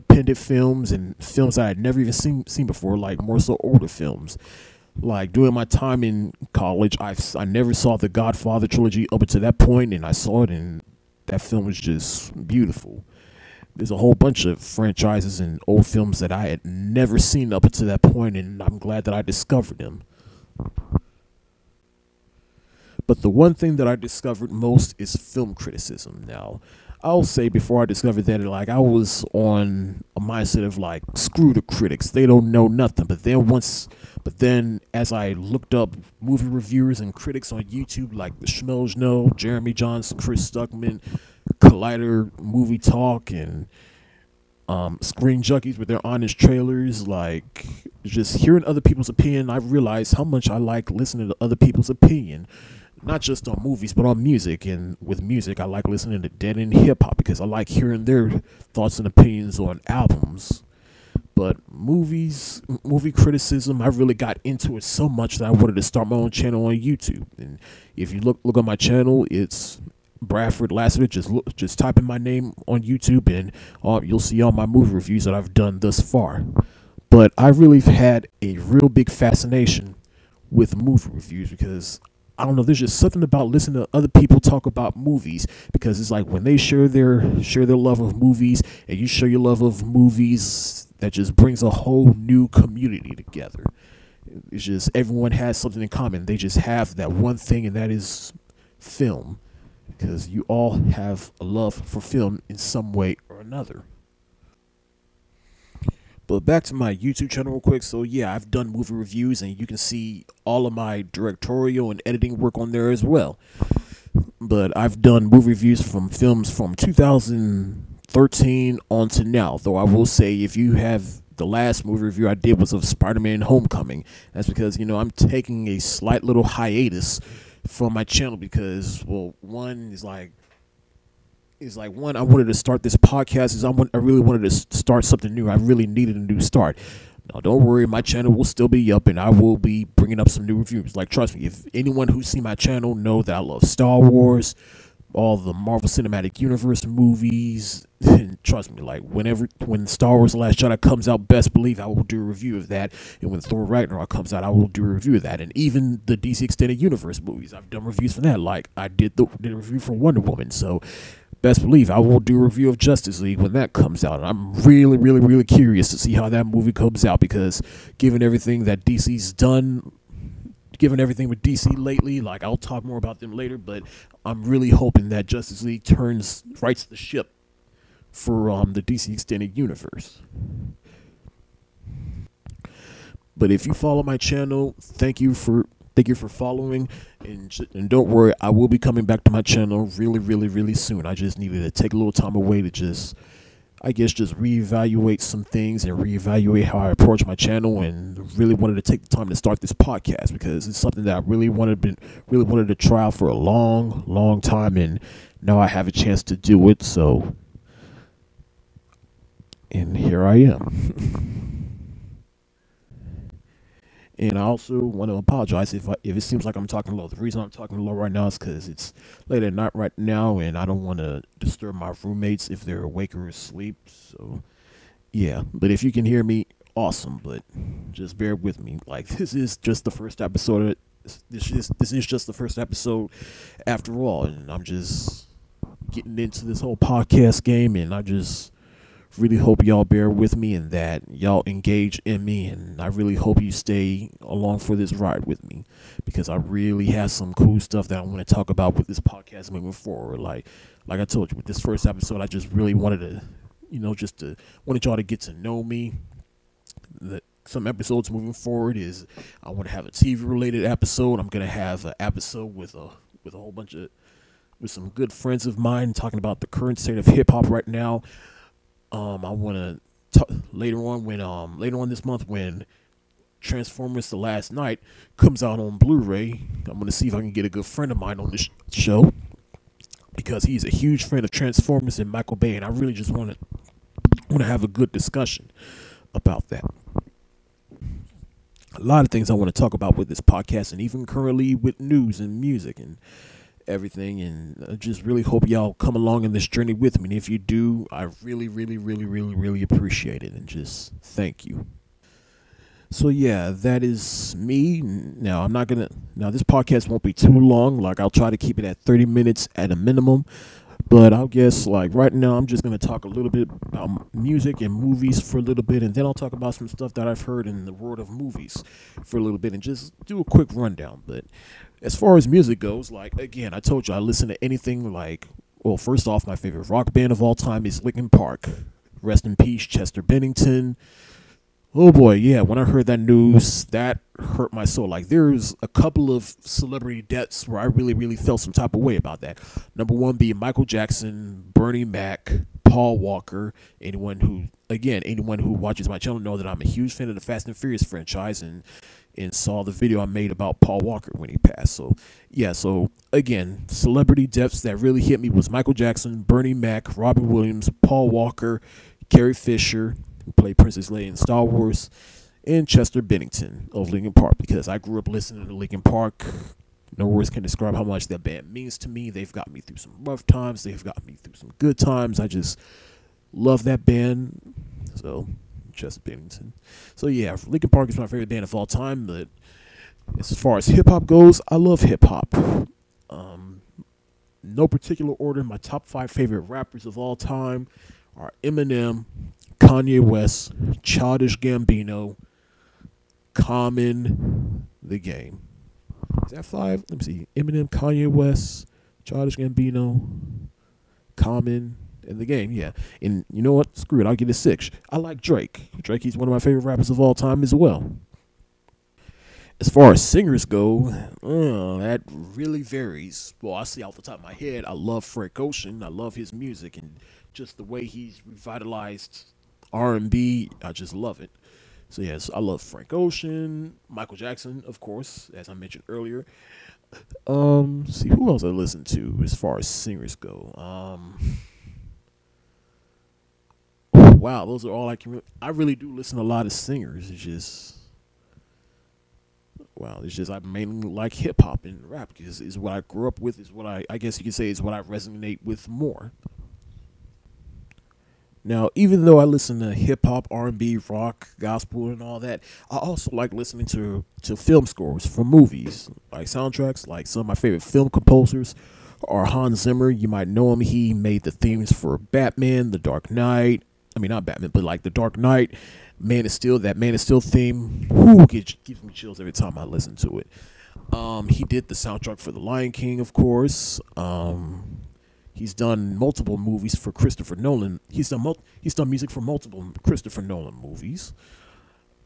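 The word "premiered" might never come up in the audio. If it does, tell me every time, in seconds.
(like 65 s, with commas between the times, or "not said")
not said.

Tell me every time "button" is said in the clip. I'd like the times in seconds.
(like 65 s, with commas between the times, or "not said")
not said.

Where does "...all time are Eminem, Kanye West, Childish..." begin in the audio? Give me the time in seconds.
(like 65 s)
386 s.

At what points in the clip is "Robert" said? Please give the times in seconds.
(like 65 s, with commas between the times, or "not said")
356 s.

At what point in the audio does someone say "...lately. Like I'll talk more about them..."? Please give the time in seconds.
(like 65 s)
171 s.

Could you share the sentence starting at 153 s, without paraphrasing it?
And when Thor: Ragnarok comes out, I will do a review of that.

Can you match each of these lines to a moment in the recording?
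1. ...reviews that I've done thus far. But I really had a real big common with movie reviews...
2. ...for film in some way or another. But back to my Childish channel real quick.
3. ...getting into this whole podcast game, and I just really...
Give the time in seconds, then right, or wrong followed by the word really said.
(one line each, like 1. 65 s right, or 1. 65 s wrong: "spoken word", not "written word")
1. 74 s wrong: "fascination", not "common"
2. 101 s wrong: "YouTube", not "Childish"
3. 235 s right.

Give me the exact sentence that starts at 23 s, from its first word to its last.
But the one thing that I discovered most is film criticism.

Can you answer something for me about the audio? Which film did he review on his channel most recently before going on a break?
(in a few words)
Spider-Man Homecoming.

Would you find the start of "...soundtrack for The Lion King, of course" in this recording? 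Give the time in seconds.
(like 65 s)
471 s.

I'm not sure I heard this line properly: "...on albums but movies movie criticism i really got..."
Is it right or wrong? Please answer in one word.
right.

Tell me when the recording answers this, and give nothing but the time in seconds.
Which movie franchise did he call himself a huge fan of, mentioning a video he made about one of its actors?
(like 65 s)
347 s.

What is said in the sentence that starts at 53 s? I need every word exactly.
Not just on movies, but on music.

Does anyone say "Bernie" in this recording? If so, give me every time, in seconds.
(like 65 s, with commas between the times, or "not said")
341 s, 356 s.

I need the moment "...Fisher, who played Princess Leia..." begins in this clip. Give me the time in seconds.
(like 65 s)
359 s.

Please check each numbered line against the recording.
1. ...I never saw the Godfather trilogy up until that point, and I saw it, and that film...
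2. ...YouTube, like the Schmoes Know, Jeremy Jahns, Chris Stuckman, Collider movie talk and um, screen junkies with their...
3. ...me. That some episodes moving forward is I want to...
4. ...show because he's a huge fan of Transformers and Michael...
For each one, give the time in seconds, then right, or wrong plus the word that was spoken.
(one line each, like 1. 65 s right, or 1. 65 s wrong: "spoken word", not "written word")
1. 7 s right
2. 37 s right
3. 255 s right
4. 278 s right.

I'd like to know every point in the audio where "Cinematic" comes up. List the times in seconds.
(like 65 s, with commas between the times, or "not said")
145 s.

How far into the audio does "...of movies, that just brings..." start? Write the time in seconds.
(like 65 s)
89 s.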